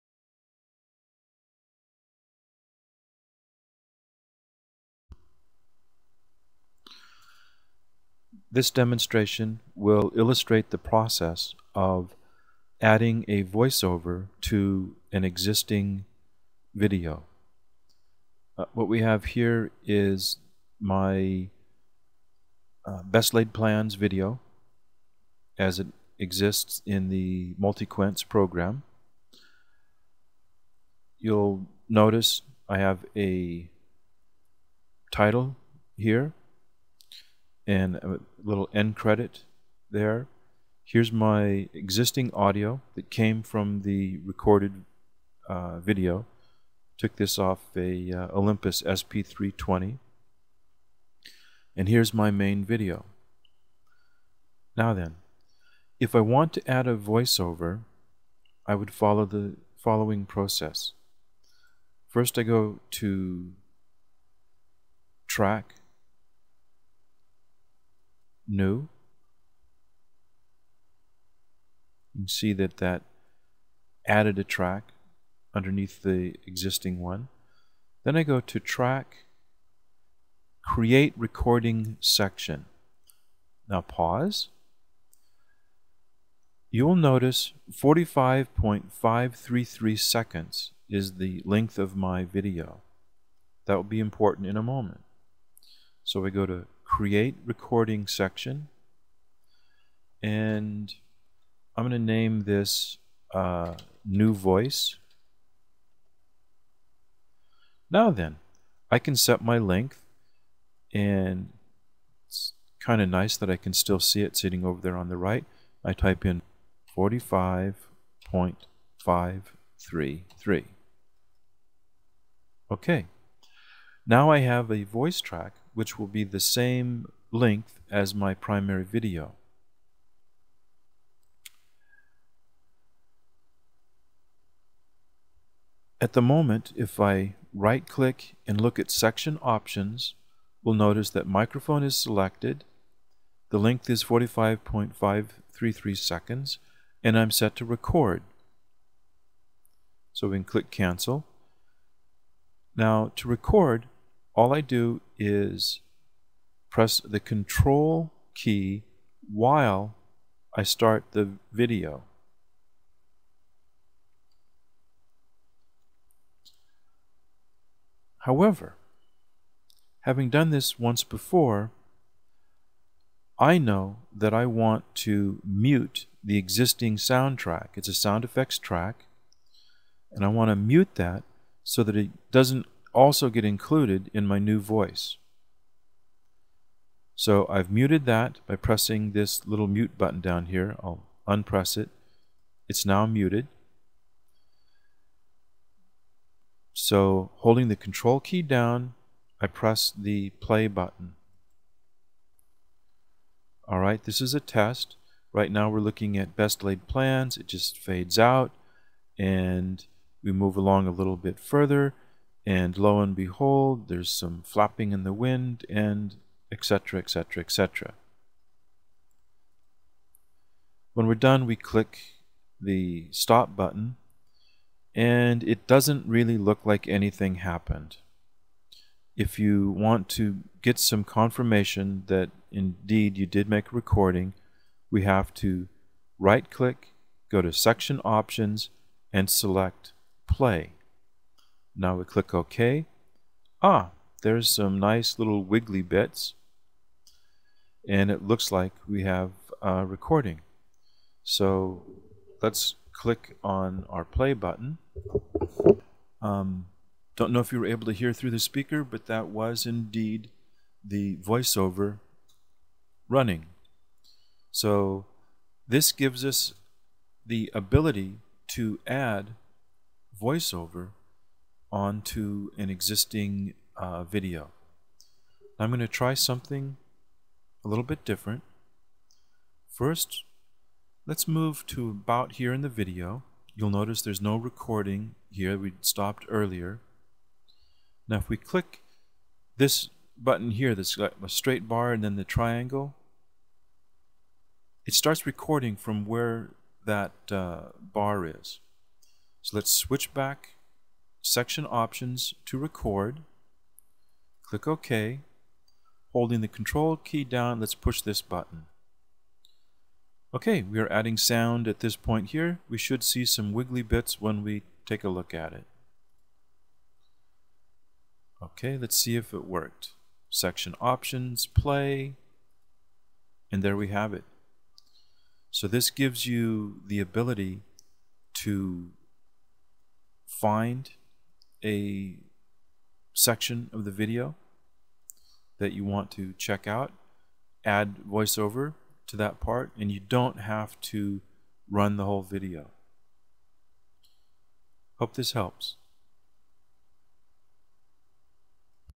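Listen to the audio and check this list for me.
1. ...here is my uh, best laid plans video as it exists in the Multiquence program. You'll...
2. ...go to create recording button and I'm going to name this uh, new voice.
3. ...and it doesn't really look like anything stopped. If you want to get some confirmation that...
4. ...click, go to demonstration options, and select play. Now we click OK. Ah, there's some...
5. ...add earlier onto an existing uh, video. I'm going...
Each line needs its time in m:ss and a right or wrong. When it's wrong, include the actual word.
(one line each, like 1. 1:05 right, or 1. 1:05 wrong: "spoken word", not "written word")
1. 0:19 right
2. 1:36 wrong: "section", not "button"
3. 3:44 wrong: "happened", not "stopped"
4. 3:56 wrong: "section", not "demonstration"
5. 4:28 wrong: "voiceover", not "earlier".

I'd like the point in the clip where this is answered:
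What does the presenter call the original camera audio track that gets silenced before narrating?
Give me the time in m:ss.
2:57.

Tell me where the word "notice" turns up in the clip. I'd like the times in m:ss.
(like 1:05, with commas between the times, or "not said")
0:31, 1:26, 2:20, 4:43.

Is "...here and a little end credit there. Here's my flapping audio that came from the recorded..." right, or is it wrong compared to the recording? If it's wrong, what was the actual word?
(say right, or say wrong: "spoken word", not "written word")
wrong: "existing", not "flapping".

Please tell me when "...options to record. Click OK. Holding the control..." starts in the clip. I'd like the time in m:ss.
5:01.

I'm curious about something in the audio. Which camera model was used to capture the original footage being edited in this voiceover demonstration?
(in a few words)
Olympus SP320.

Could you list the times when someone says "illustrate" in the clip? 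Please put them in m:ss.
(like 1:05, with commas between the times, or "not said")
0:10.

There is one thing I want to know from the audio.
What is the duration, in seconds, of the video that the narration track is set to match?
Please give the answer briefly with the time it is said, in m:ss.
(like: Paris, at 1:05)
45.533, at 1:27.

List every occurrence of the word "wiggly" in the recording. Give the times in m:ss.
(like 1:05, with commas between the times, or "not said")
4:05, 5:13.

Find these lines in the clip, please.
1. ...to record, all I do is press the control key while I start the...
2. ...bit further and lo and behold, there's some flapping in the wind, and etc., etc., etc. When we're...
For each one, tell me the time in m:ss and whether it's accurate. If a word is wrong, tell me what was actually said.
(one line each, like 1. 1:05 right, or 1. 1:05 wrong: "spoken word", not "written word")
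1. 2:33 right
2. 3:31 right.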